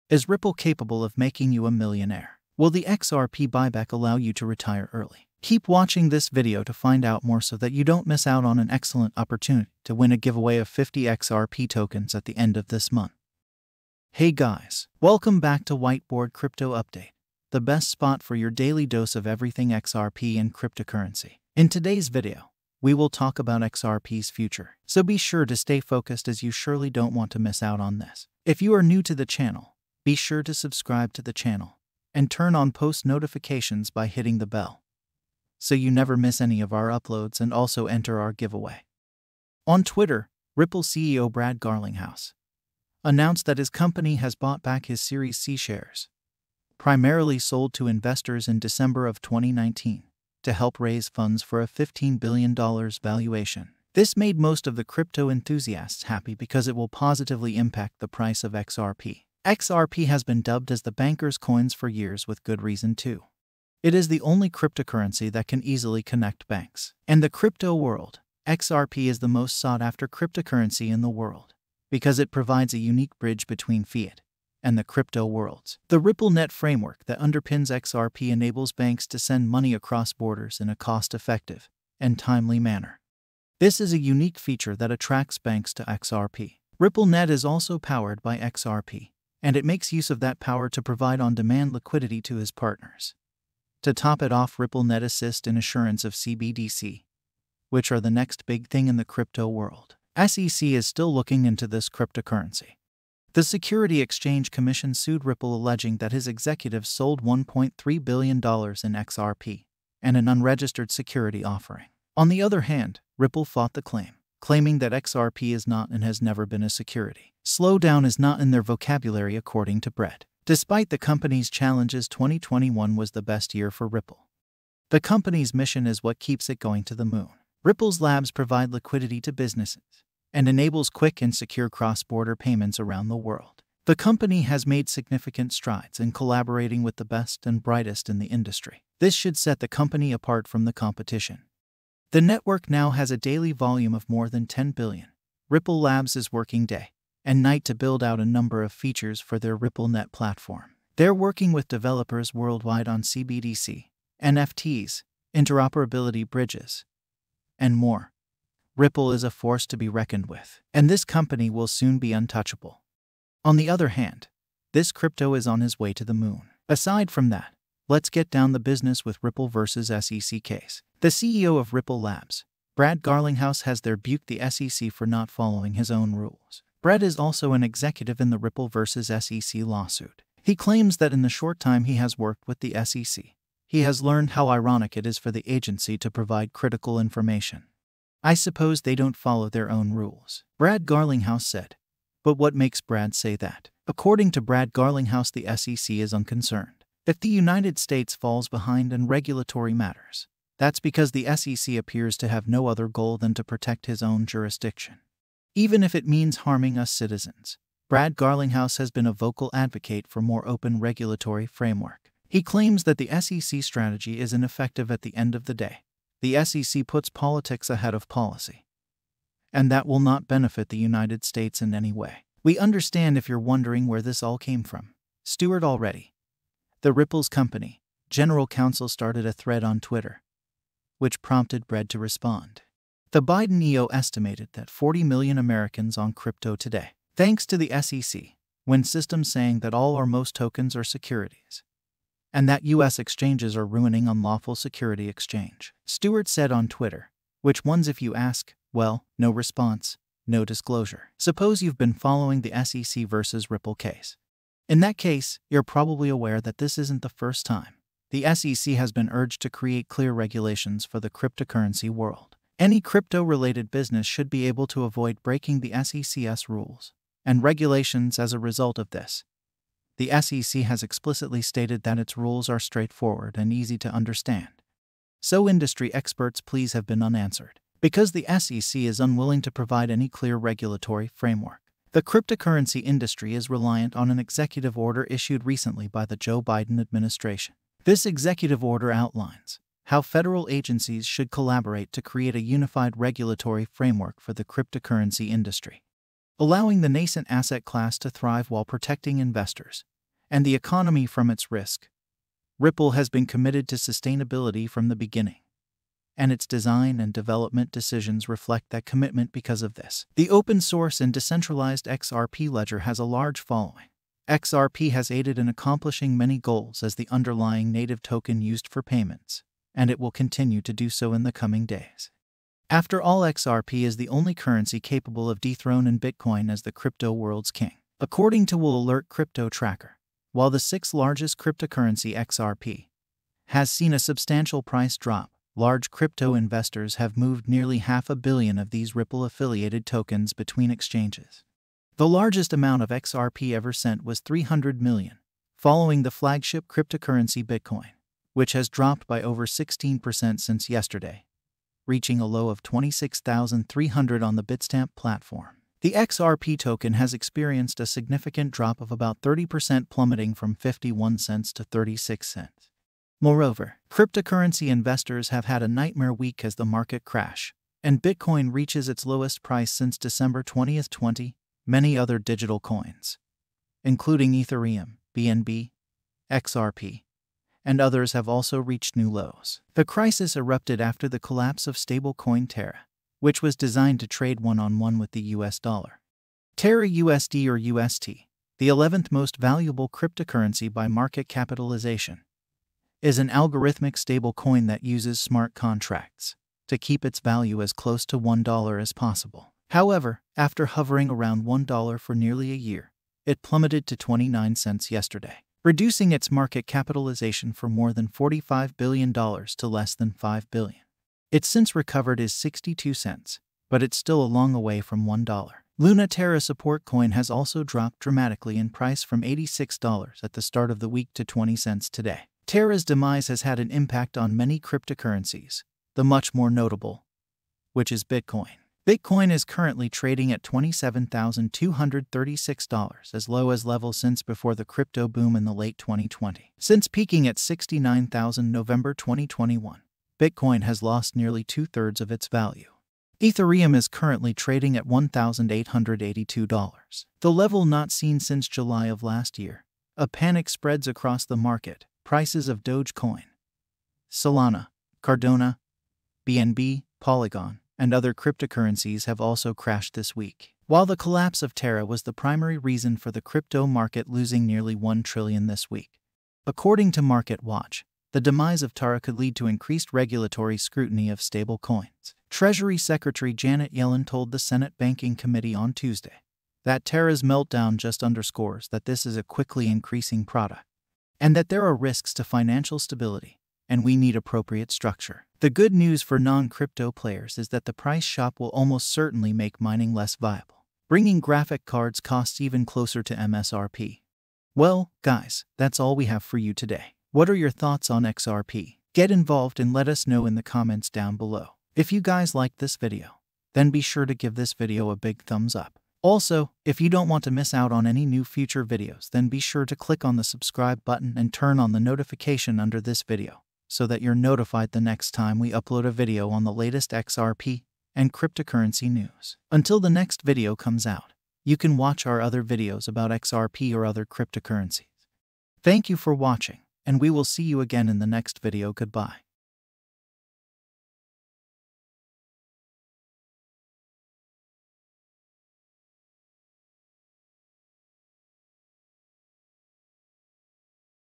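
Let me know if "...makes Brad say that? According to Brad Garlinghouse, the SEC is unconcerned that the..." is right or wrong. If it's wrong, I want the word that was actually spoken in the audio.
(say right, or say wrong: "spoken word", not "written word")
right.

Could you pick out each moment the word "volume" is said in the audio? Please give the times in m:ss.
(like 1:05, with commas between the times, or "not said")
2:23.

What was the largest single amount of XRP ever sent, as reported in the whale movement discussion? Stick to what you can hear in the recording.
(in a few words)
300 million.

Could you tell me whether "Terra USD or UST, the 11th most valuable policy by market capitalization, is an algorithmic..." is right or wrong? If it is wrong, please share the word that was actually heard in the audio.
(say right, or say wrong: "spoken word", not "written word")
wrong: "cryptocurrency", not "policy".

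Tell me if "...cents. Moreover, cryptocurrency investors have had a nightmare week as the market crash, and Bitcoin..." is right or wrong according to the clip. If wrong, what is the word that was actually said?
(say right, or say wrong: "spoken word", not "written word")
right.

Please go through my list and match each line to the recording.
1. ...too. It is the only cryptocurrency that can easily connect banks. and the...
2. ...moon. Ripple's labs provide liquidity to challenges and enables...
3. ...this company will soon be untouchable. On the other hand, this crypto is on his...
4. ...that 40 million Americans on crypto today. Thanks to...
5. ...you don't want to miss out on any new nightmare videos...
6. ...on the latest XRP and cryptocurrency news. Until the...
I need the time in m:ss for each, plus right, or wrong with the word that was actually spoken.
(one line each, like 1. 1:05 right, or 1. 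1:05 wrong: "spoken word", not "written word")
1. 1:02 right
2. 2:07 wrong: "businesses", not "challenges"
3. 2:40 right
4. 3:54 right
5. 8:26 wrong: "future", not "nightmare"
6. 8:36 right.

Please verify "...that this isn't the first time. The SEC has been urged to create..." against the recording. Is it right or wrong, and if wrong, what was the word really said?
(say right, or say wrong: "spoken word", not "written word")
right.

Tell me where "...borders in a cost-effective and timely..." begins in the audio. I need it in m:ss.
1:20.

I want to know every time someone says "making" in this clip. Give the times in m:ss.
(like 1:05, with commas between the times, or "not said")
0:01.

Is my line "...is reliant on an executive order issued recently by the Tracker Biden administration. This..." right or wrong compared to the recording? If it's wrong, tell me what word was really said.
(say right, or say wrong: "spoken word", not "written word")
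wrong: "Joe", not "Tracker".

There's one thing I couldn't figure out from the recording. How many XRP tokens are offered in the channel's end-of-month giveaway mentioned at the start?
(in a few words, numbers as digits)
50.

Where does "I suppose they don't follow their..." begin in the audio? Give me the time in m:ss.
3:08.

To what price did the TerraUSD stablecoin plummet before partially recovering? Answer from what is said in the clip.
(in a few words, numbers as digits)
29 cents.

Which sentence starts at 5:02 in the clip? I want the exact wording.
Ripple has been committed to sustainability from the beginning and its design and development decisions reflect that commitment because of this.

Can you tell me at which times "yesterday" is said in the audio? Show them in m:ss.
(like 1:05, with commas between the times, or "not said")
5:50, 6:44.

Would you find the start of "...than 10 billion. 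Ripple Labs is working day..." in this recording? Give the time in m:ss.
2:24.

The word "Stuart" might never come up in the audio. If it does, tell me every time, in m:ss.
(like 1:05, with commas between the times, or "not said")
3:45, 4:05.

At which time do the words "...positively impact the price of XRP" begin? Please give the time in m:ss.
0:56.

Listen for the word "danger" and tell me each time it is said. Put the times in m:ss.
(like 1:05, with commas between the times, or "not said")
not said.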